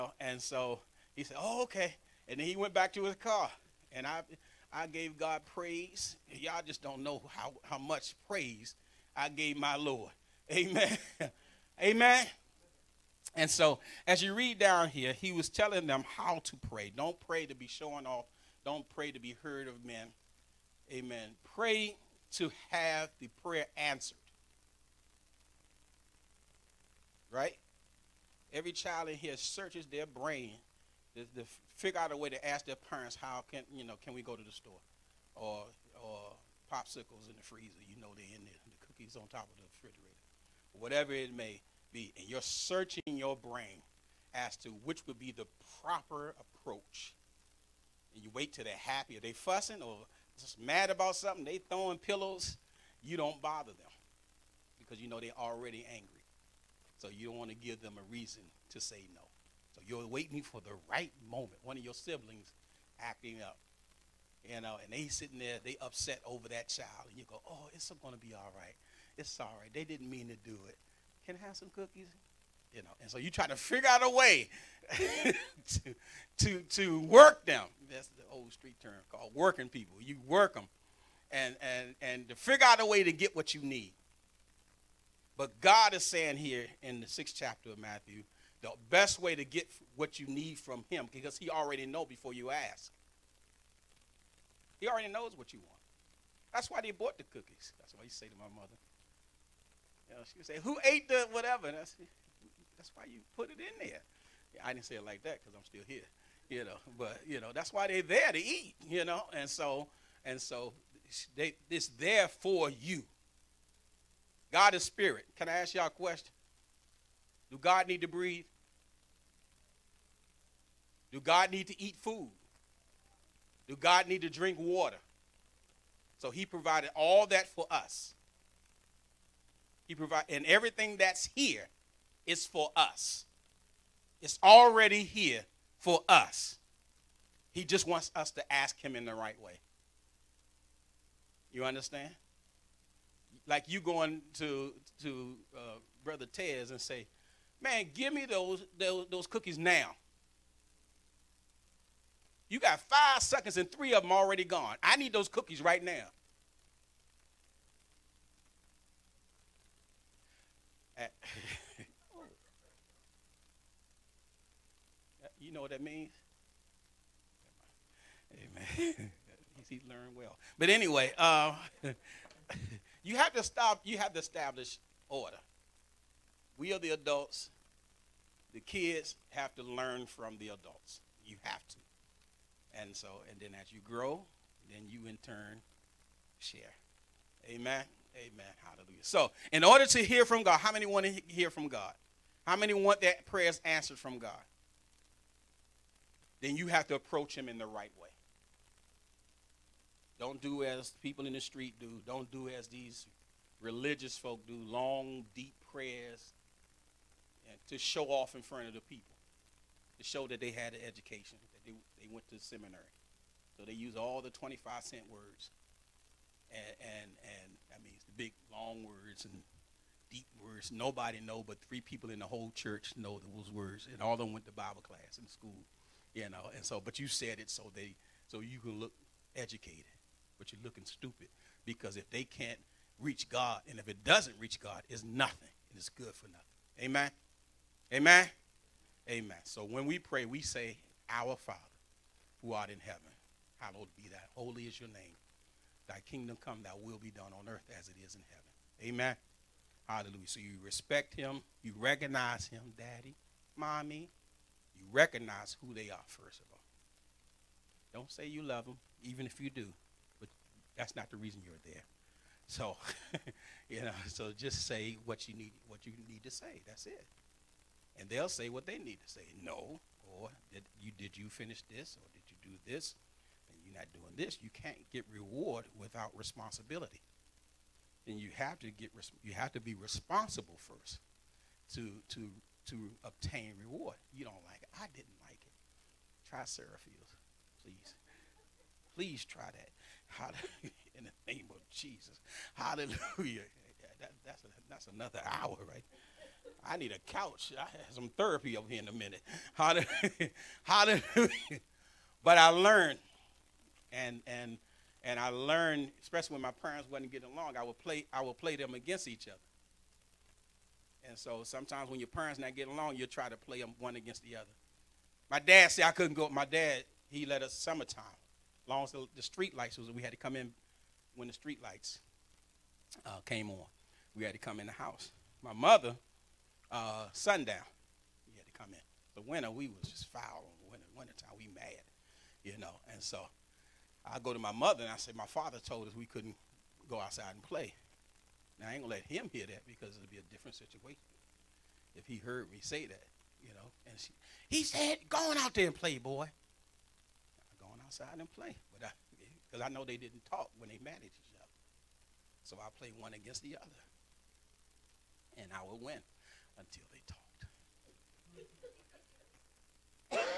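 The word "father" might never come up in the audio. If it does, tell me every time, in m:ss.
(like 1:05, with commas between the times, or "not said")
4:01, 5:35.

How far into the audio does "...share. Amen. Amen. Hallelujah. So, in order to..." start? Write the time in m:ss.
3:06.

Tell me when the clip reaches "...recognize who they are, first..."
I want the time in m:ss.
4:14.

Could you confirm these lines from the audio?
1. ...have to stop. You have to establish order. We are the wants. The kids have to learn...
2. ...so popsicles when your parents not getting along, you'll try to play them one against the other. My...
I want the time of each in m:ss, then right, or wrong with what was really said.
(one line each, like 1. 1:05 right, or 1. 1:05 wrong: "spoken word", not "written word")
1. 2:53 wrong: "adults", not "wants"
2. 5:11 wrong: "sometimes", not "popsicles".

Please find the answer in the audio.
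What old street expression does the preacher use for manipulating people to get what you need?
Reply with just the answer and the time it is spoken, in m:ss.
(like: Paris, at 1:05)
working people, at 1:19.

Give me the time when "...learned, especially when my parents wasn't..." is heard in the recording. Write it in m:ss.
5:05.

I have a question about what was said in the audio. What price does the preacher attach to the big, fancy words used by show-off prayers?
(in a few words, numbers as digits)
25 cents.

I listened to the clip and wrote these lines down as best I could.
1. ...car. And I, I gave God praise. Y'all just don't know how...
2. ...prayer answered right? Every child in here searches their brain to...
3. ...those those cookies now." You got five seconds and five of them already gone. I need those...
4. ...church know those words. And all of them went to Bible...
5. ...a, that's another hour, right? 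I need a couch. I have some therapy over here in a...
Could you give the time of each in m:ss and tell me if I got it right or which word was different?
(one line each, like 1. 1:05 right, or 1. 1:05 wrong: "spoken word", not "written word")
1. 0:03 right
2. 0:23 right
3. 2:28 wrong: "three", not "five"
4. 3:42 right
5. 4:54 right.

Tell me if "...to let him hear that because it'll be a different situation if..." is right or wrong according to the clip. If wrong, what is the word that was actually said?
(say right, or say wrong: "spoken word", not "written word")
right.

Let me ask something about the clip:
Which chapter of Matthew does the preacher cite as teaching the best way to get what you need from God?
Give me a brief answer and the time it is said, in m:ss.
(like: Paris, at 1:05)
sixth, at 1:27.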